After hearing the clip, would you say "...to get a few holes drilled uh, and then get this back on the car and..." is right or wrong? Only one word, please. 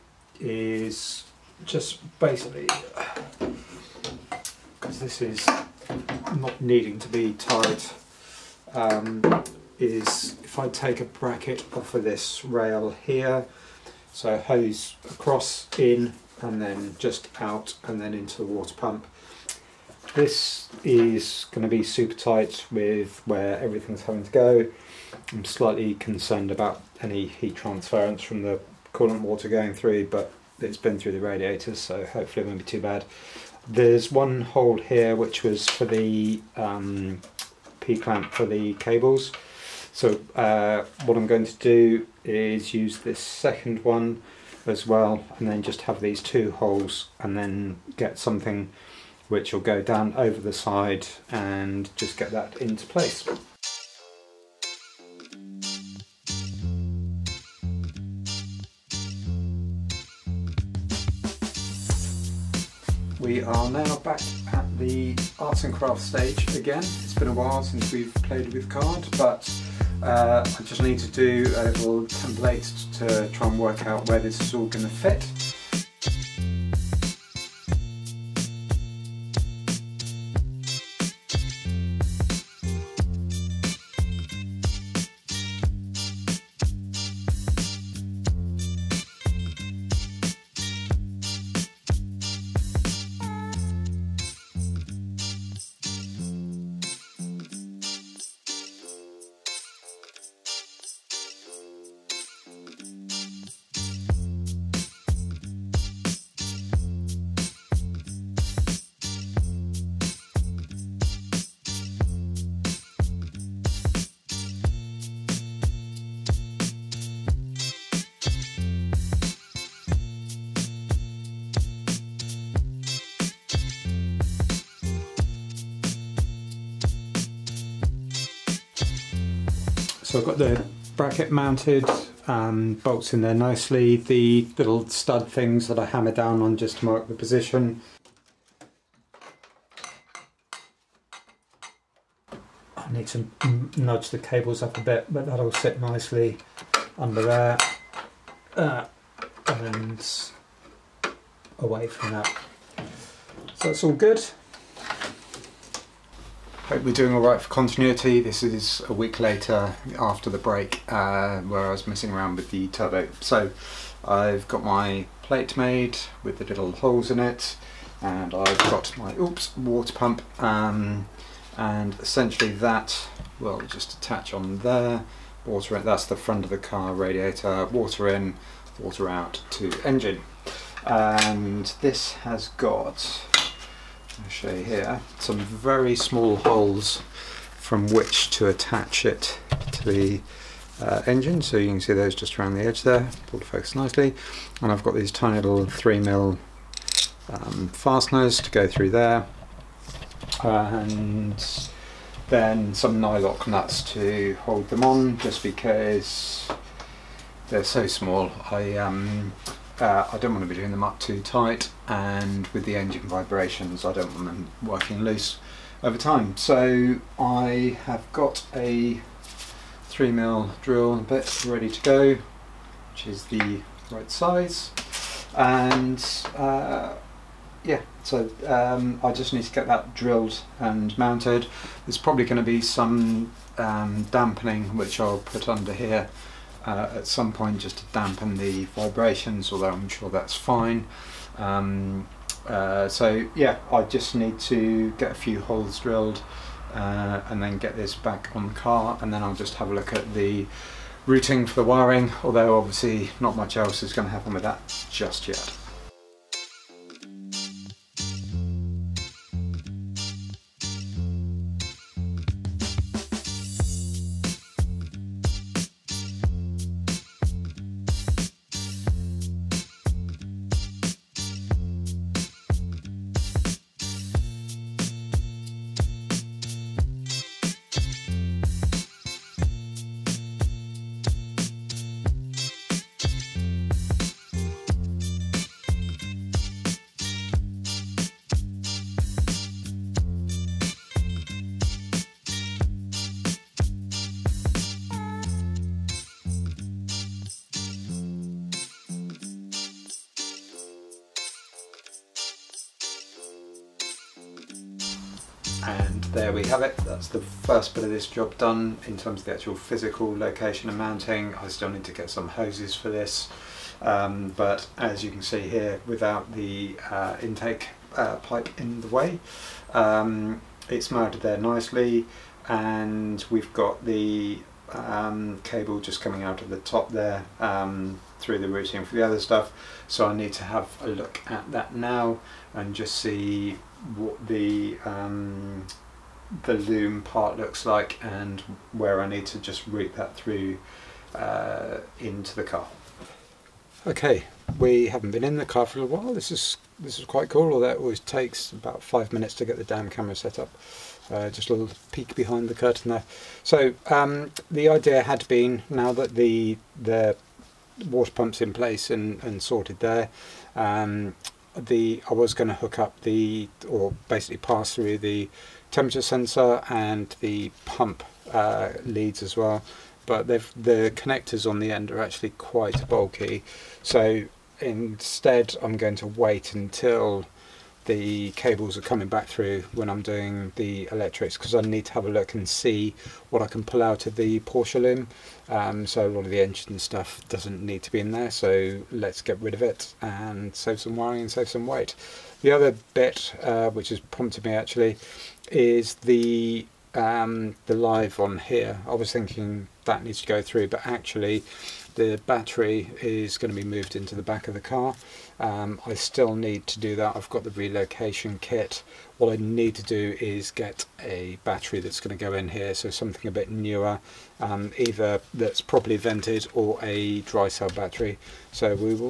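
right.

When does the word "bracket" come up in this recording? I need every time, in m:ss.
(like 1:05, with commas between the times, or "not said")
0:11, 2:10.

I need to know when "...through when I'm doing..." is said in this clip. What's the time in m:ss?
6:19.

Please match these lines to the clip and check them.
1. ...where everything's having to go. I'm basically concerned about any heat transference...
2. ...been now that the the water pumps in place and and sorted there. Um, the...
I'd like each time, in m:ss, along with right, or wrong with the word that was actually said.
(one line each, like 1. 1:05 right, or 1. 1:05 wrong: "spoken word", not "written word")
1. 0:23 wrong: "slightly", not "basically"
2. 5:55 right.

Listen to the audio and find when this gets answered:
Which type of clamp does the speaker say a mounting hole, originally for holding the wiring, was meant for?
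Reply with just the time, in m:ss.
0:37.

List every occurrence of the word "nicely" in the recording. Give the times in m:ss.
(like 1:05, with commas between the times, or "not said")
2:13, 2:25, 3:13, 5:21.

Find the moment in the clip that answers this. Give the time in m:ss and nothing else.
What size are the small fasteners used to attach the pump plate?
3:15.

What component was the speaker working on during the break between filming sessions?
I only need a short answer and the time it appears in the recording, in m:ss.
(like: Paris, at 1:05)
turbo, at 2:42.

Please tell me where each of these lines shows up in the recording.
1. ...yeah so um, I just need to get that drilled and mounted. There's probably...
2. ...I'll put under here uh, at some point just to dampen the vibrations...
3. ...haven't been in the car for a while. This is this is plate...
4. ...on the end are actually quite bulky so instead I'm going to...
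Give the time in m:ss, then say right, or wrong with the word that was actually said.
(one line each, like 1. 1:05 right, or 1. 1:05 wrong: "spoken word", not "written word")
1. 3:47 right
2. 3:55 right
3. 5:44 wrong: "quite", not "plate"
4. 6:11 right.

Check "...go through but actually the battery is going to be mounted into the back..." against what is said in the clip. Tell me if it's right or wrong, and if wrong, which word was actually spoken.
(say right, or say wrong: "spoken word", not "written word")
wrong: "moved", not "mounted".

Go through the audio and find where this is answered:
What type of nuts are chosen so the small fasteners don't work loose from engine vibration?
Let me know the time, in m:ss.
3:23.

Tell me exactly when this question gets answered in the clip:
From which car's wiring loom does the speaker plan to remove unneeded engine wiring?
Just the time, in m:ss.
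6:24.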